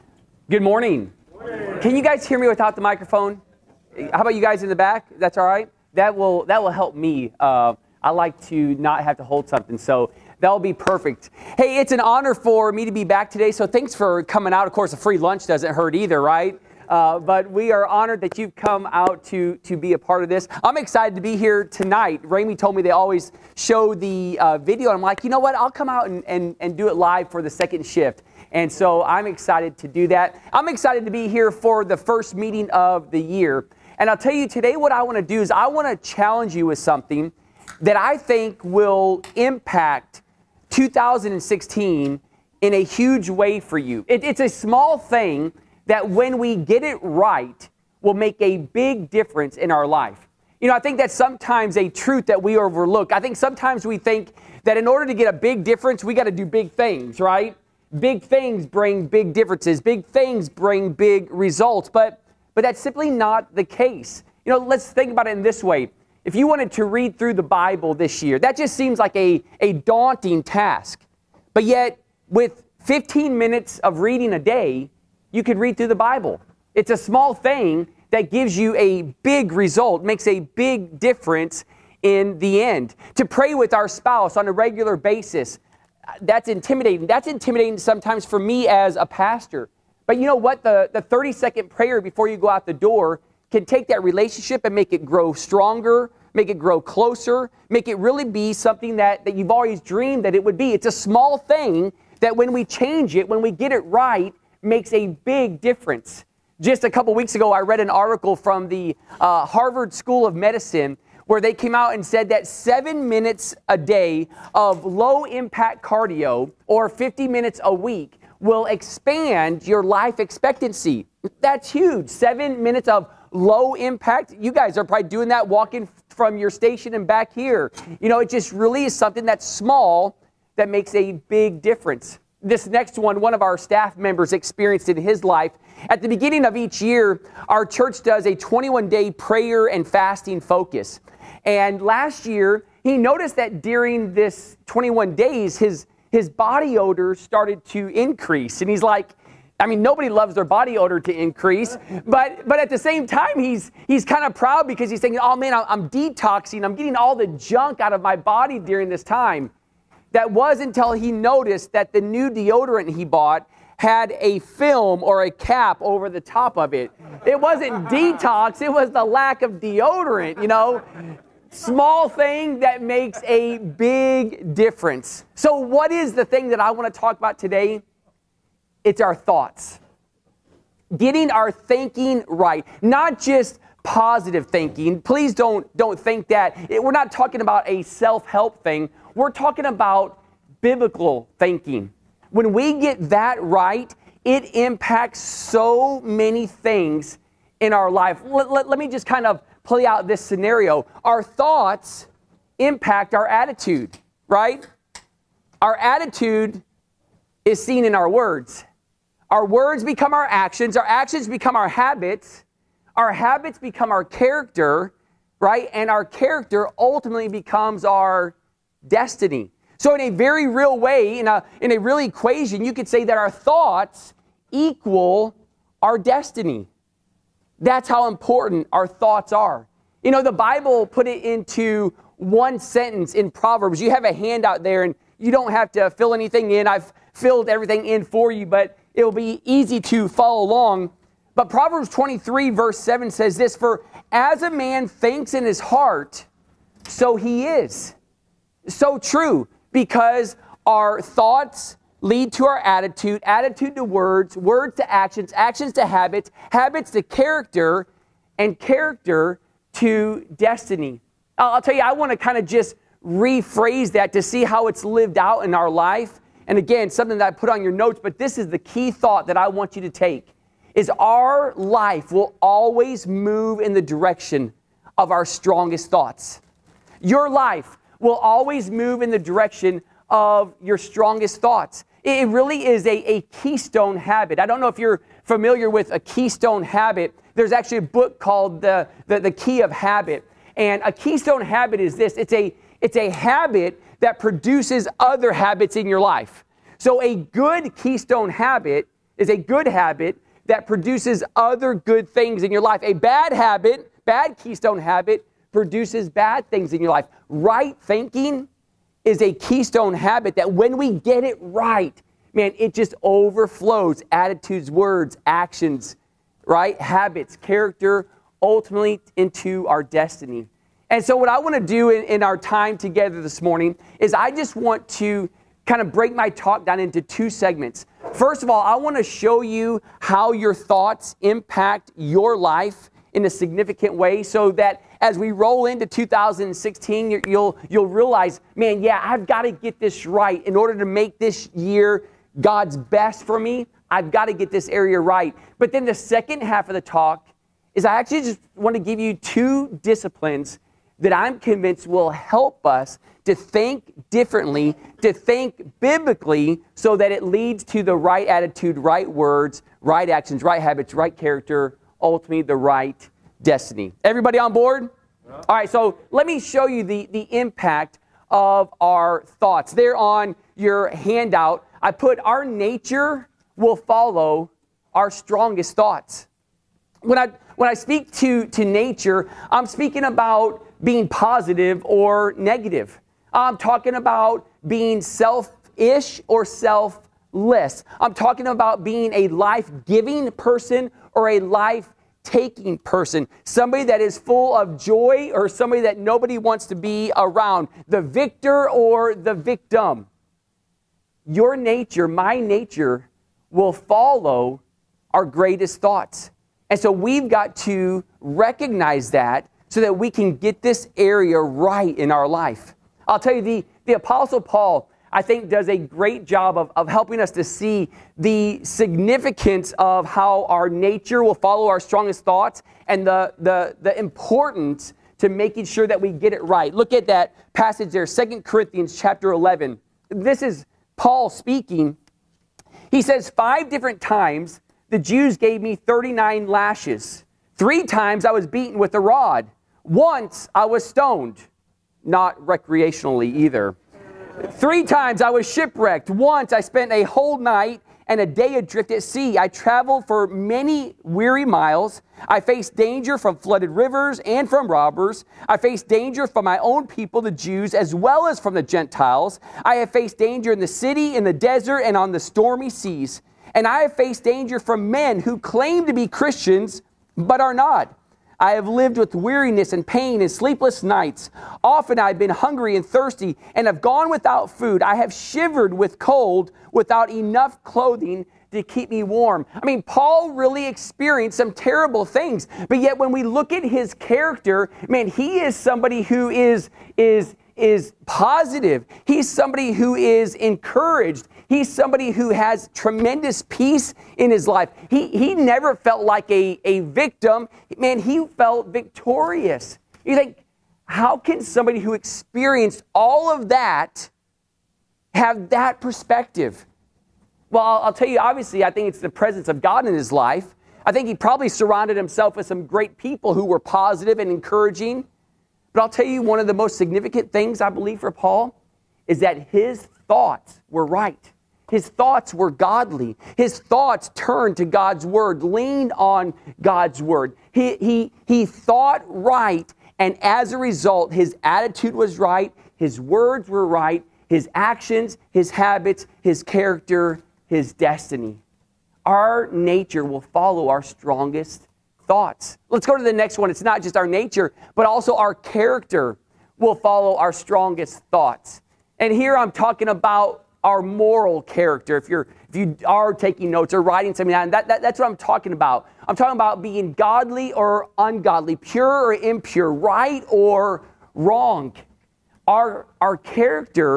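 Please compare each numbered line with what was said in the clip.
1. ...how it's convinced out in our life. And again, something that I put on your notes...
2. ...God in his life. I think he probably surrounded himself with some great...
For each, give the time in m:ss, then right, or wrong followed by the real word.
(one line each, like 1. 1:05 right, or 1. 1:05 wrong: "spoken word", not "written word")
1. 4:24 wrong: "lived", not "convinced"
2. 8:29 right.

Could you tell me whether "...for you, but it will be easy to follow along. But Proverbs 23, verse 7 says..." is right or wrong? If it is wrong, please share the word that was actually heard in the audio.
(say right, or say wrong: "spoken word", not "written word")
right.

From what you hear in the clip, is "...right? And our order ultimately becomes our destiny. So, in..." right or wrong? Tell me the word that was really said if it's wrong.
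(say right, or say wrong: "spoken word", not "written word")
wrong: "character", not "order".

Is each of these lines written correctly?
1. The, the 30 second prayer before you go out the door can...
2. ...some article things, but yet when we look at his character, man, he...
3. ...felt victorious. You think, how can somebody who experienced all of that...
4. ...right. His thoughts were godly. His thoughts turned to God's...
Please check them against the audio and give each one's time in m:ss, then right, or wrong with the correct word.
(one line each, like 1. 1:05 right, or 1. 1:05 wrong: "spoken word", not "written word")
1. 1:30 right
2. 8:01 wrong: "terrible", not "article"
3. 8:18 right
4. 8:40 right.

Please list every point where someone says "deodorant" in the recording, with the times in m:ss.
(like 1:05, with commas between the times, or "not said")
2:42, 2:49.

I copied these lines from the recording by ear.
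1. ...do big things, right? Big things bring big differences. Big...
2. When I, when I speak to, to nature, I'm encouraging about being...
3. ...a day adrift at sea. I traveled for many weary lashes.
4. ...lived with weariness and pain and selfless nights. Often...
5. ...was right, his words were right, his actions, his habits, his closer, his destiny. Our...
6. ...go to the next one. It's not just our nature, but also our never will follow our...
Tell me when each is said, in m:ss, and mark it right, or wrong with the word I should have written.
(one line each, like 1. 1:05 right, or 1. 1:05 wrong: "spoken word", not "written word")
1. 0:56 right
2. 6:17 wrong: "speaking", not "encouraging"
3. 7:28 wrong: "miles", not "lashes"
4. 7:48 wrong: "sleepless", not "selfless"
5. 8:51 wrong: "character", not "closer"
6. 9:02 wrong: "character", not "never".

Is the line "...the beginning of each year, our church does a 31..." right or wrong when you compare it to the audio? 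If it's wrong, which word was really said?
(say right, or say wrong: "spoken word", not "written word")
wrong: "21", not "31".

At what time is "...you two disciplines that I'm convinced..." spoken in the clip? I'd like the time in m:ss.
5:48.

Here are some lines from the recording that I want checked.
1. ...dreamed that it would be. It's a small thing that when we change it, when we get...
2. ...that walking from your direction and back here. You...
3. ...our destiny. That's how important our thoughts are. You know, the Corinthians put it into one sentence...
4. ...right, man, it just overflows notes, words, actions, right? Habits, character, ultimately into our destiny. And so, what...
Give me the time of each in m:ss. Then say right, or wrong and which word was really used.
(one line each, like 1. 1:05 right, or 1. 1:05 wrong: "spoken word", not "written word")
1. 1:39 right
2. 2:05 wrong: "station", not "direction"
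3. 3:45 wrong: "Bible", not "Corinthians"
4. 5:11 wrong: "attitudes", not "notes".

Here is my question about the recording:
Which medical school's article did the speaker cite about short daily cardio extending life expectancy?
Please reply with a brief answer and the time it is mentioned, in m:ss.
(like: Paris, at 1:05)
Harvard School of Medicine, at 1:49.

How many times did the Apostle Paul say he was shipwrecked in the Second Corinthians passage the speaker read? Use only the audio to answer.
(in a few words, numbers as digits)
3.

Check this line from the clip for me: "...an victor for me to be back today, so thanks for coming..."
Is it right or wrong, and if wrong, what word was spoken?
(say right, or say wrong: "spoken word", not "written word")
wrong: "honor", not "victor".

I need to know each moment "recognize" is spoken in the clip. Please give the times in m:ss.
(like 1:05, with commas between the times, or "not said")
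6:48.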